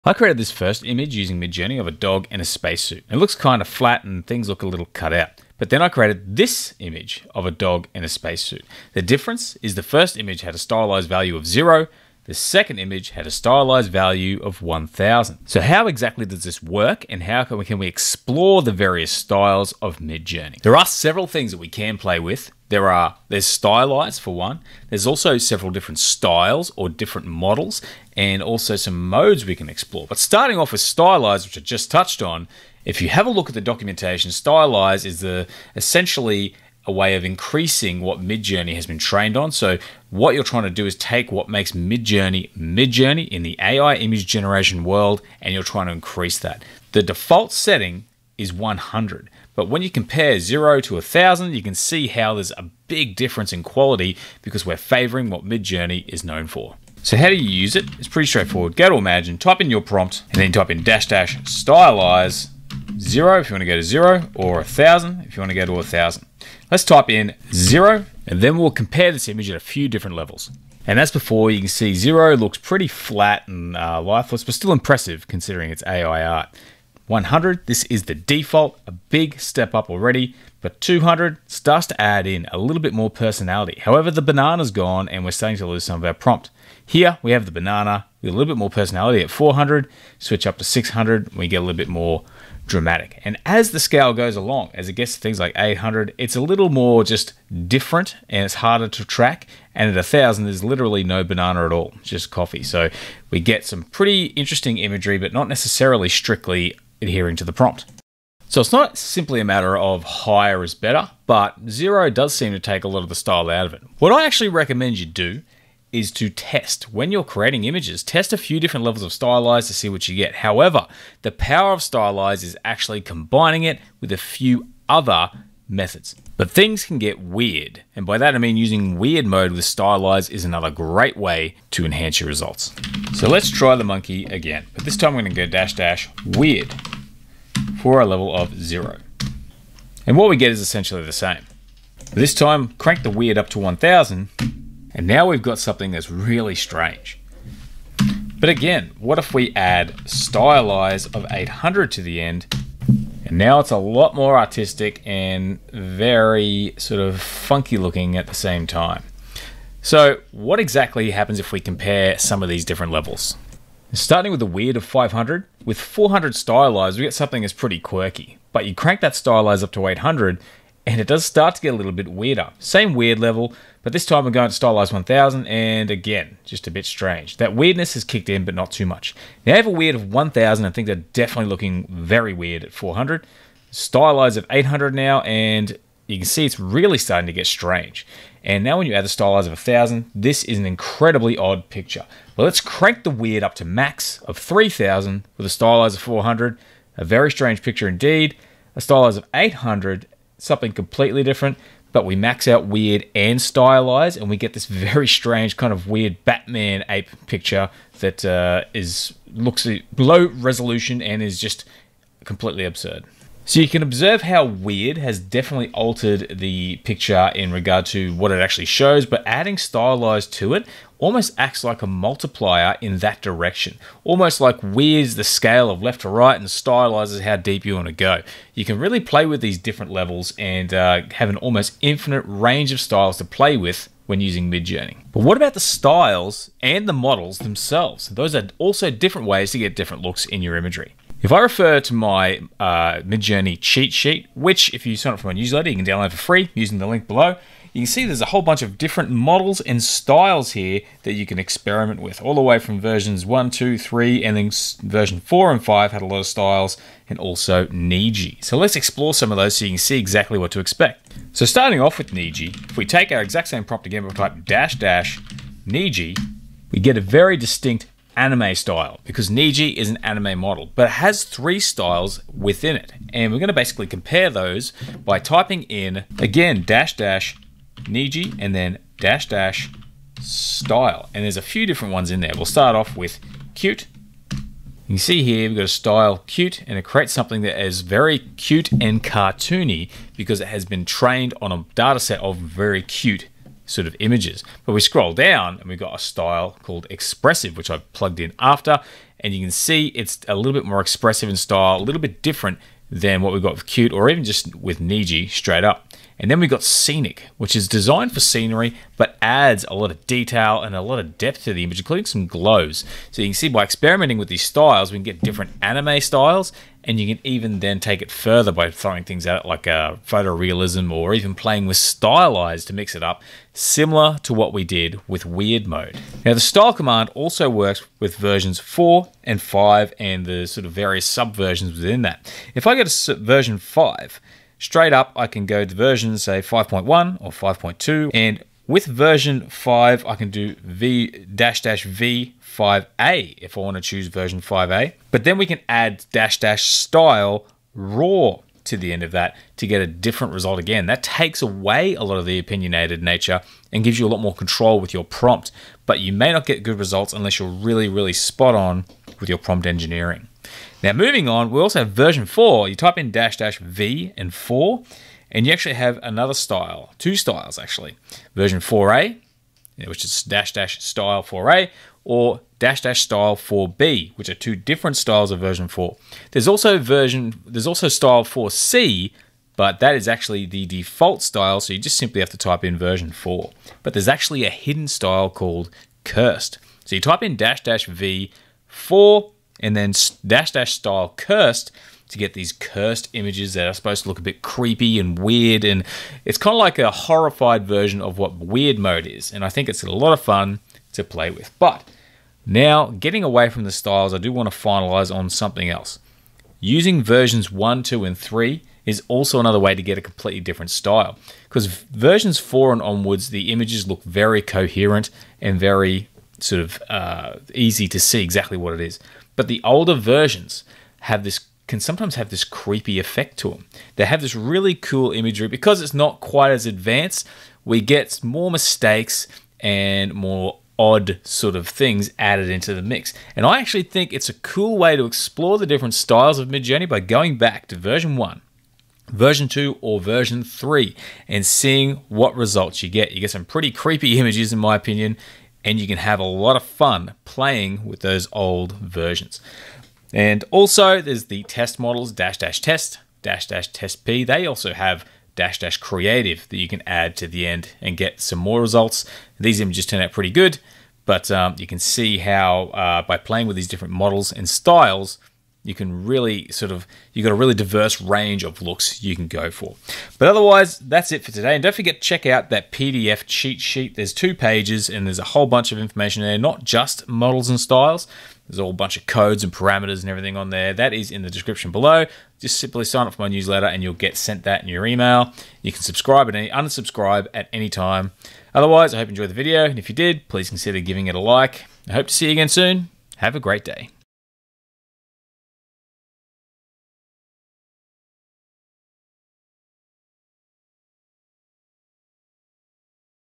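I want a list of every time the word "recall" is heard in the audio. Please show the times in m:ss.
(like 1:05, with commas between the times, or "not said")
not said.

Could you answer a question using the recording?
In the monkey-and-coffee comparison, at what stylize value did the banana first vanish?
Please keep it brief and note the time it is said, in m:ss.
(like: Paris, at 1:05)
200, at 1:20.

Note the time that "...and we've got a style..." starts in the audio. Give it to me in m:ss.
4:55.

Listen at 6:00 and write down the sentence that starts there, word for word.
Now, moving on, we also have version 4.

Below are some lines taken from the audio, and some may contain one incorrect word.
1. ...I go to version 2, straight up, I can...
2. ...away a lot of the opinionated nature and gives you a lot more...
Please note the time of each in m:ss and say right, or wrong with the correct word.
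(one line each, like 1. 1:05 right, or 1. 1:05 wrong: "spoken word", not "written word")
1. 5:32 wrong: "5", not "2"
2. 5:51 right.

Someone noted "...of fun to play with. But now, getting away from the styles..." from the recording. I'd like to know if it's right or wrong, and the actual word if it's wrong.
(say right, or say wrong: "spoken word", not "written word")
right.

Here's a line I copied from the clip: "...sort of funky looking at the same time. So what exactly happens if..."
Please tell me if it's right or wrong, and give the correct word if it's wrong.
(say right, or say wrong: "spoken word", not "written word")
right.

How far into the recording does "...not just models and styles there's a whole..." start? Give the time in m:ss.
7:56.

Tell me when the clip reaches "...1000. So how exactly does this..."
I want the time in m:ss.
0:14.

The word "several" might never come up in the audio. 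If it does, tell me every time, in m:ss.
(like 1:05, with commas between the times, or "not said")
0:20, 0:25.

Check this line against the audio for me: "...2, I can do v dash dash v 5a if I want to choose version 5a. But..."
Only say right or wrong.
wrong.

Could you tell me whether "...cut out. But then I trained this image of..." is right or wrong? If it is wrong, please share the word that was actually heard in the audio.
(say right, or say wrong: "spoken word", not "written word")
wrong: "created", not "trained".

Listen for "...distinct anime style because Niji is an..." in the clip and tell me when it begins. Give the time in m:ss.
4:27.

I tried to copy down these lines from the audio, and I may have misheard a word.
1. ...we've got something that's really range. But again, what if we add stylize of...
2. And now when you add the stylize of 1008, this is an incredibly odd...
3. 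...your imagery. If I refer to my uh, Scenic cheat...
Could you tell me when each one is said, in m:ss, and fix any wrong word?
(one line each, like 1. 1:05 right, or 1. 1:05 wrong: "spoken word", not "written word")
1. 2:25 wrong: "strange", not "range"
2. 3:08 wrong: "1000", not "1008"
3. 4:00 wrong: "Midjourney", not "Scenic".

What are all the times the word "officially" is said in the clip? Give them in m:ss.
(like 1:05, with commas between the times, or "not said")
not said.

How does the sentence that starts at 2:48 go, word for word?
But you crank that stylize up to 800, and it does start to get a little bit weirder.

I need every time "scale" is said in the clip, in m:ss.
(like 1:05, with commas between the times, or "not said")
1:33, 3:45.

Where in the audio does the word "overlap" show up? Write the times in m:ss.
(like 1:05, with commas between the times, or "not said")
not said.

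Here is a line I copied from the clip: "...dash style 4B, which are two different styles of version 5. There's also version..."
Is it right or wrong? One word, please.
wrong.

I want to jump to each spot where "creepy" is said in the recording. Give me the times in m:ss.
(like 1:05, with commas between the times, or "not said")
6:34, 7:02, 7:23.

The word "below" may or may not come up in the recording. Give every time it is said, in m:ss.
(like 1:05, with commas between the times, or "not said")
4:07, 8:01.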